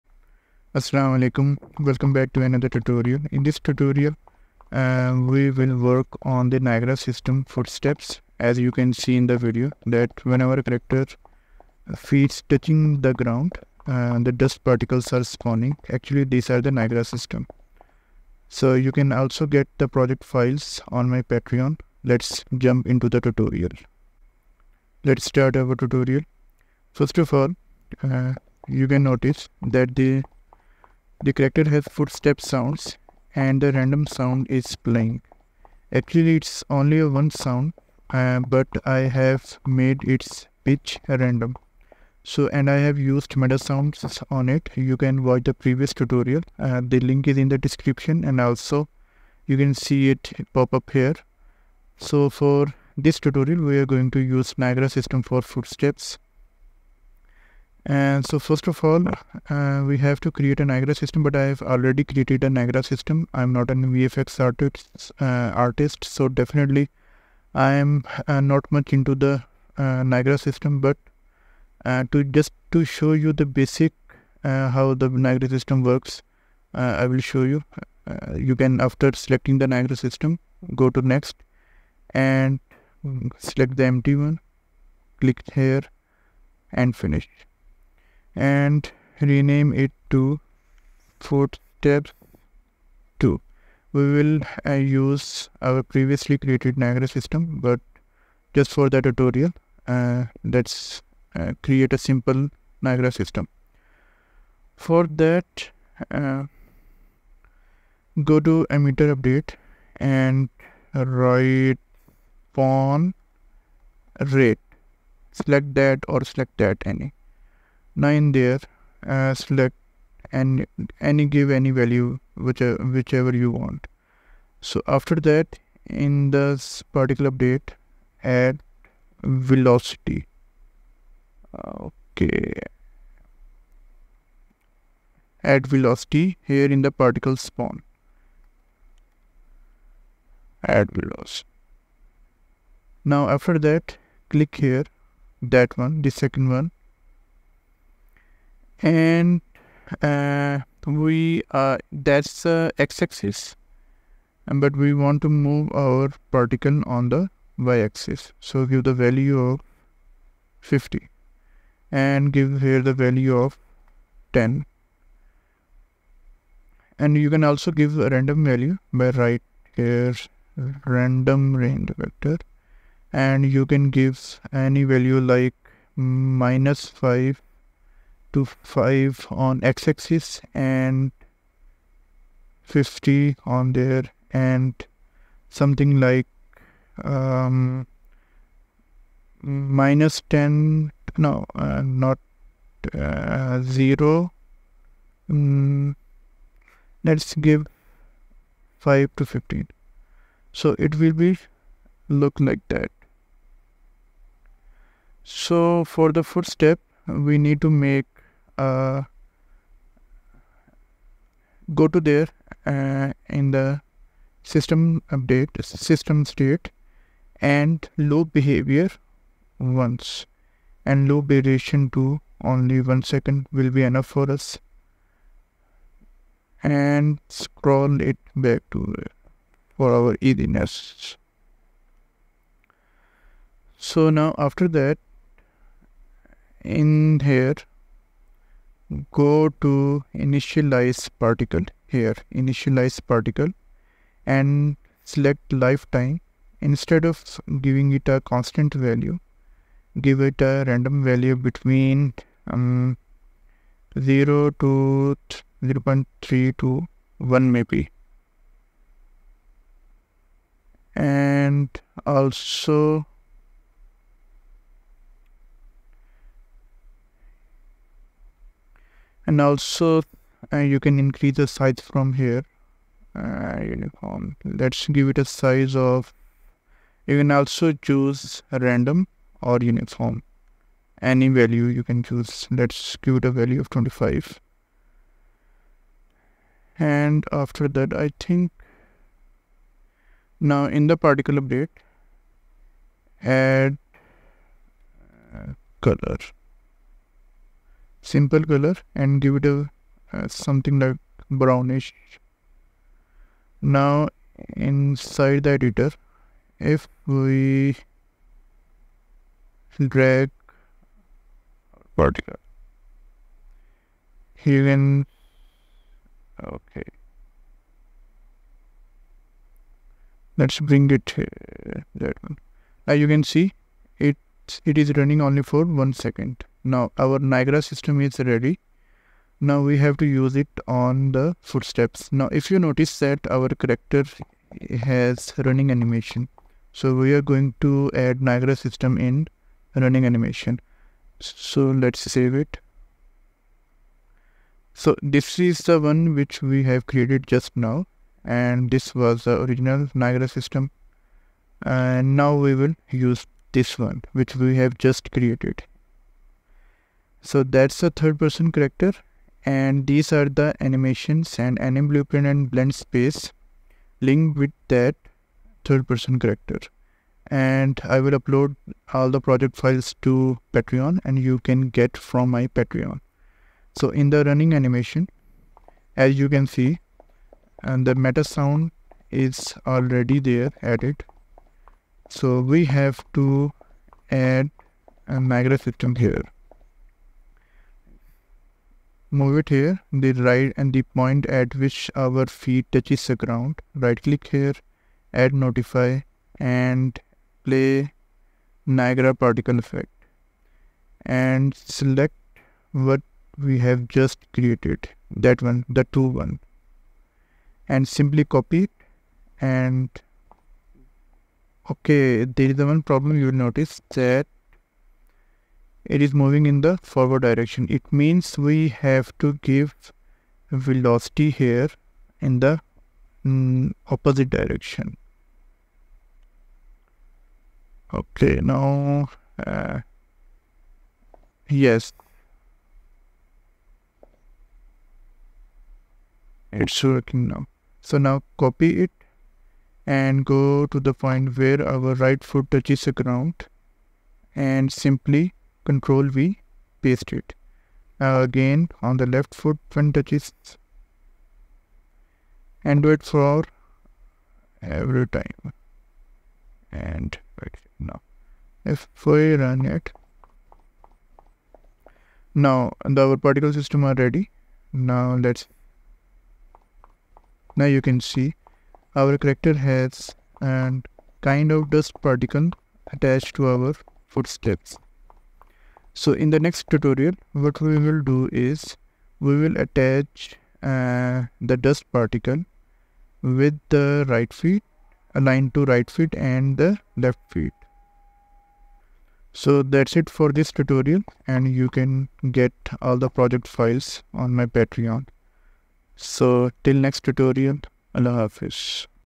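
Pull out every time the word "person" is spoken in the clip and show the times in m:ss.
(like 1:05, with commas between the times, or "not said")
5:58, 6:05.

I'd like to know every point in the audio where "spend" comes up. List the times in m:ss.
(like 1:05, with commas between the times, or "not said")
not said.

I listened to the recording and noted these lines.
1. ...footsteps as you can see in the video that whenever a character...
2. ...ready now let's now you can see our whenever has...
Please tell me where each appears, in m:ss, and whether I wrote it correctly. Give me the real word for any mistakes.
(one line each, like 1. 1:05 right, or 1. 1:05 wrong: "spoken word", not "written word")
1. 0:07 right
2. 7:44 wrong: "character", not "whenever".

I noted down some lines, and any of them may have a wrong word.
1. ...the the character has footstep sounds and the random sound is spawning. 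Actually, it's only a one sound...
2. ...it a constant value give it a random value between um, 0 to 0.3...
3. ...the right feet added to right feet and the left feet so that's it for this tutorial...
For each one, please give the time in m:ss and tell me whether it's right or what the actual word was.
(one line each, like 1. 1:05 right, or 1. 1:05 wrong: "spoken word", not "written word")
1. 0:29 wrong: "playing", not "spawning"
2. 4:07 right
3. 8:03 wrong: "aligned", not "added".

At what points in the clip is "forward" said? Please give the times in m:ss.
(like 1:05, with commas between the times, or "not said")
6:56.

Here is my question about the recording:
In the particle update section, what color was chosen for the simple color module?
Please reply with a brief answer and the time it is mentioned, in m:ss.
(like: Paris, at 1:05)
brownish, at 5:01.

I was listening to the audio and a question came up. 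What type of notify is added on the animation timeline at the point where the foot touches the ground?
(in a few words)
Play Niagara particle effect.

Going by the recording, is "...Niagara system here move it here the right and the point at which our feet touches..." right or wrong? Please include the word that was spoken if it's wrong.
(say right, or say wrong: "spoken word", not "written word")
right.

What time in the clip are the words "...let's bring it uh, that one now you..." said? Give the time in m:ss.
5:20.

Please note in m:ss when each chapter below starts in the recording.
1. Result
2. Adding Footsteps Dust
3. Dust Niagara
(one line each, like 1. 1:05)
1. 7:44
2. 5:25
3. 0:23.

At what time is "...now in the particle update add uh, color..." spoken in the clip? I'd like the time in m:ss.
4:50.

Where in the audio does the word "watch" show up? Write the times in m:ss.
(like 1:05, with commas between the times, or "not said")
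0:45.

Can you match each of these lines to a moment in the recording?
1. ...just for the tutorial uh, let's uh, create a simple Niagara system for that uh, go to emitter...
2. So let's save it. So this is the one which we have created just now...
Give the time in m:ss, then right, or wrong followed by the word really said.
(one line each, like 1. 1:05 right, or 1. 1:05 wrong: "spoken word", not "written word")
1. 1:38 right
2. 5:41 right.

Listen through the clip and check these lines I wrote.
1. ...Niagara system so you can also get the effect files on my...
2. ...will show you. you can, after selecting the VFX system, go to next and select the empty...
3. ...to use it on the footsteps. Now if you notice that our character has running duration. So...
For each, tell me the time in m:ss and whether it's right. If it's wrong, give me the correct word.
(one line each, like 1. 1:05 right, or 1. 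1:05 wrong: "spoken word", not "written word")
1. 0:16 wrong: "project", not "effect"
2. 1:17 wrong: "Niagara", not "VFX"
3. 5:29 wrong: "animation", not "duration".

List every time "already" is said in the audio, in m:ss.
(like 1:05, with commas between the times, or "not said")
1:01, 6:19.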